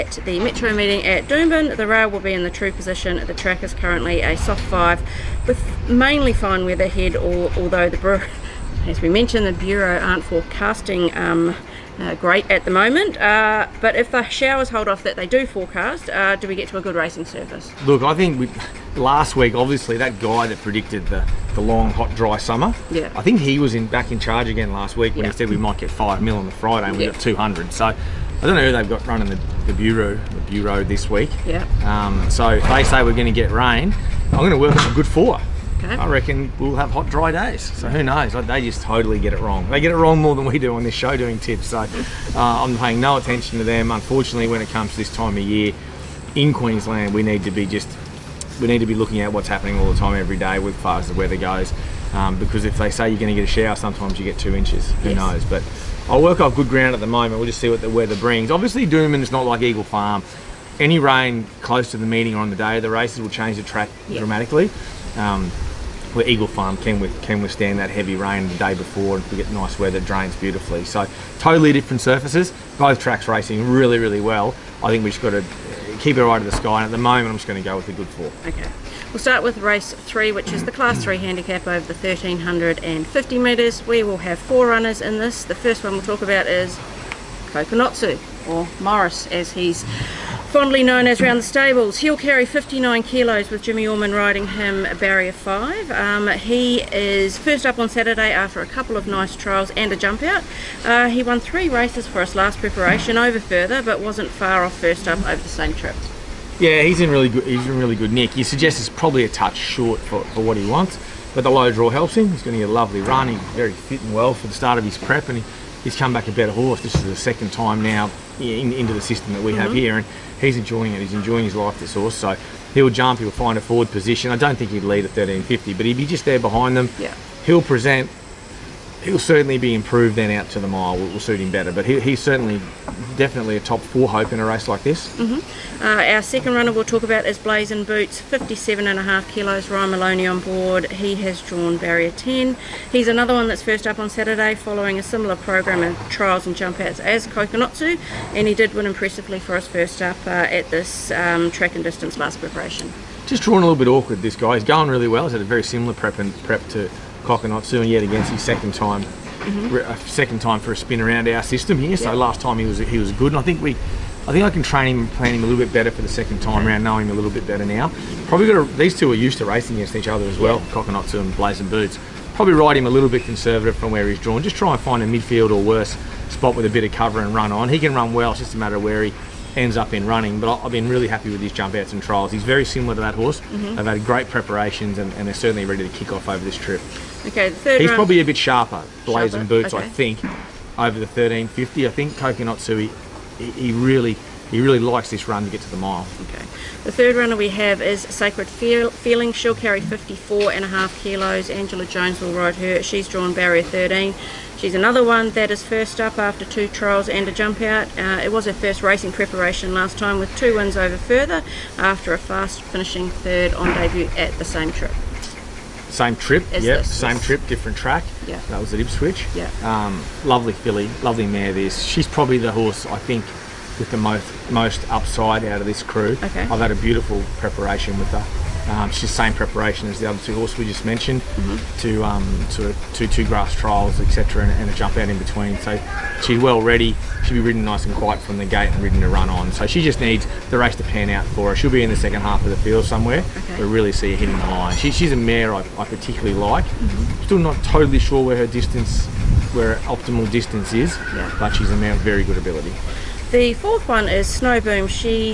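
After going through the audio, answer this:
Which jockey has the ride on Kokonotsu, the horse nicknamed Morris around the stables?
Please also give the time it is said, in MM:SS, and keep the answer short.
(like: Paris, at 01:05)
Jimmy Orman, at 01:33.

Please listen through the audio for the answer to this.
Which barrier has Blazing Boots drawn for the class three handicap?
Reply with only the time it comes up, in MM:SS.
02:21.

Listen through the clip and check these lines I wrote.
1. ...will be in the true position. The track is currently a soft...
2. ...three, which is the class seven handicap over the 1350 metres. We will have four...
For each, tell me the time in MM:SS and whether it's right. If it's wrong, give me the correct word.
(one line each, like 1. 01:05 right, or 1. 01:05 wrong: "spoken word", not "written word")
1. 00:02 right
2. 01:19 wrong: "three", not "seven".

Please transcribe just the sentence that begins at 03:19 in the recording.
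She'll carry 54 and a half kilos.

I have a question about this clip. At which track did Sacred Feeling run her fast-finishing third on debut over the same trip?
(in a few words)
Ipswich.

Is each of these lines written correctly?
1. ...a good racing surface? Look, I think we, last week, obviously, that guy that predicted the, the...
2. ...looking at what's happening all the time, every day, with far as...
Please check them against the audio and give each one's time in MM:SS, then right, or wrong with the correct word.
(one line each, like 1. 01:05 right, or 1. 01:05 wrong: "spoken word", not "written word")
1. 00:16 right
2. 00:48 right.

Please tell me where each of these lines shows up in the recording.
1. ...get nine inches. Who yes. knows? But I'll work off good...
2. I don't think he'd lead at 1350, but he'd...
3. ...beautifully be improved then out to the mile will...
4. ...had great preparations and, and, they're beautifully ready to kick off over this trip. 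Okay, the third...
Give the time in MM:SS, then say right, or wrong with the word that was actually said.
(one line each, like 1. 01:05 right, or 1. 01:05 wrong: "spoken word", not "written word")
1. 00:54 wrong: "two", not "nine"
2. 02:04 right
3. 02:09 wrong: "certainly", not "beautifully"
4. 03:03 wrong: "certainly", not "beautifully".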